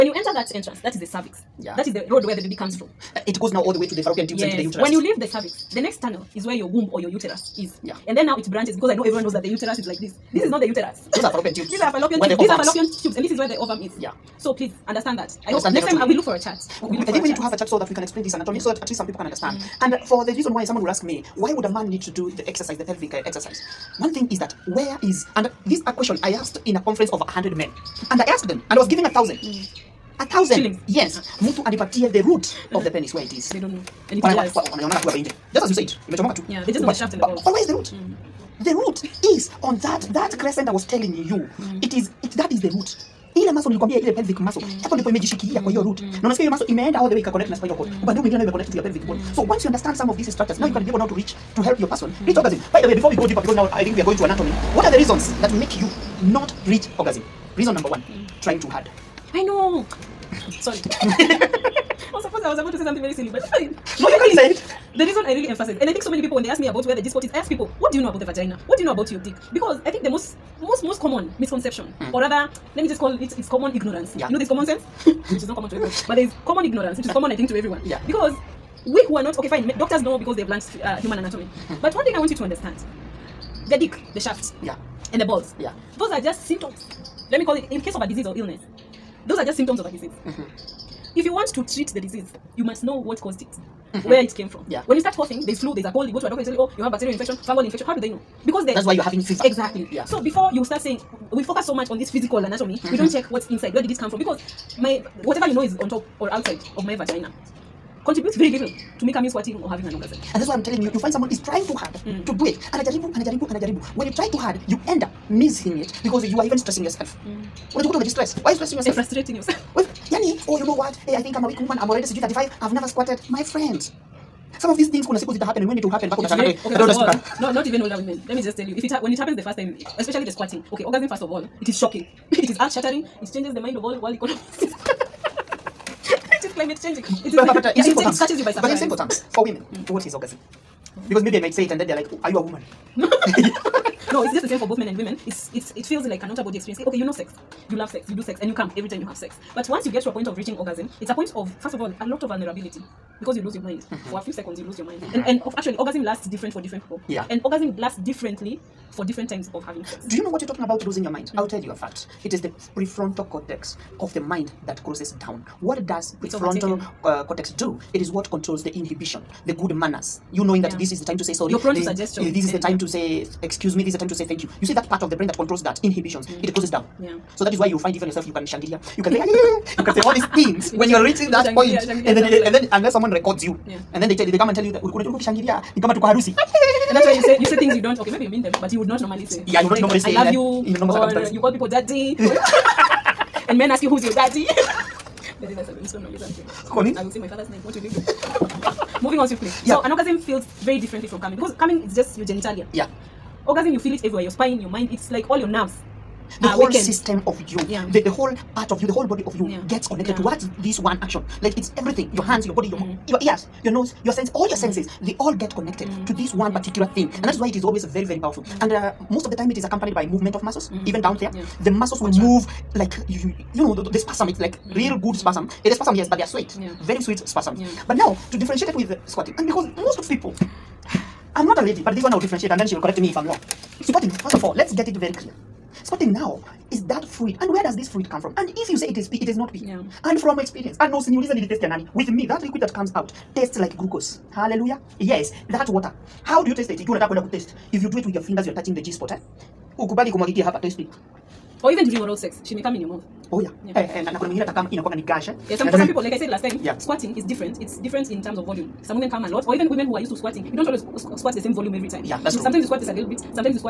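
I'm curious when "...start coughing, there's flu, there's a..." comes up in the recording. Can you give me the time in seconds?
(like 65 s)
94 s.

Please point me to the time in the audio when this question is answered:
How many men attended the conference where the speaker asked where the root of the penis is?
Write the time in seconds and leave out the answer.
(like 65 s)
27 s.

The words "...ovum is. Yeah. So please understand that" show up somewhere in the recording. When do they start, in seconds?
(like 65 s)
13 s.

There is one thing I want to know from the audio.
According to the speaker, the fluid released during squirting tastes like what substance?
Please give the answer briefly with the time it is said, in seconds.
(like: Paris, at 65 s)
glucose, at 243 s.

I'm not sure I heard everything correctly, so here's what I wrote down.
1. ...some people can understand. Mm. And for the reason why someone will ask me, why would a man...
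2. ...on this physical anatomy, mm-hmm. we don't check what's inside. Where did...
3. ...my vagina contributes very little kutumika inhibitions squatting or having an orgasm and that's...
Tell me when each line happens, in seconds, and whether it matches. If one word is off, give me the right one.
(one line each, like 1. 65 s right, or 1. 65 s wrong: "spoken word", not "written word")
1. 18 s right
2. 101 s right
3. 106 s wrong: "means", not "inhibitions".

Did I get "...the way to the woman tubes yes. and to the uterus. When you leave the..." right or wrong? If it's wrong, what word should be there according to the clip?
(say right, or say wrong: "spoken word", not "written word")
wrong: "fallopian", not "woman".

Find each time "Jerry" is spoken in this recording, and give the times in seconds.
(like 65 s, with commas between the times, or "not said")
not said.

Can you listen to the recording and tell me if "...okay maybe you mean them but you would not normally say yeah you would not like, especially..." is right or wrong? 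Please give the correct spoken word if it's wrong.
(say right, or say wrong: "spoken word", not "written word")
wrong: "normally", not "especially".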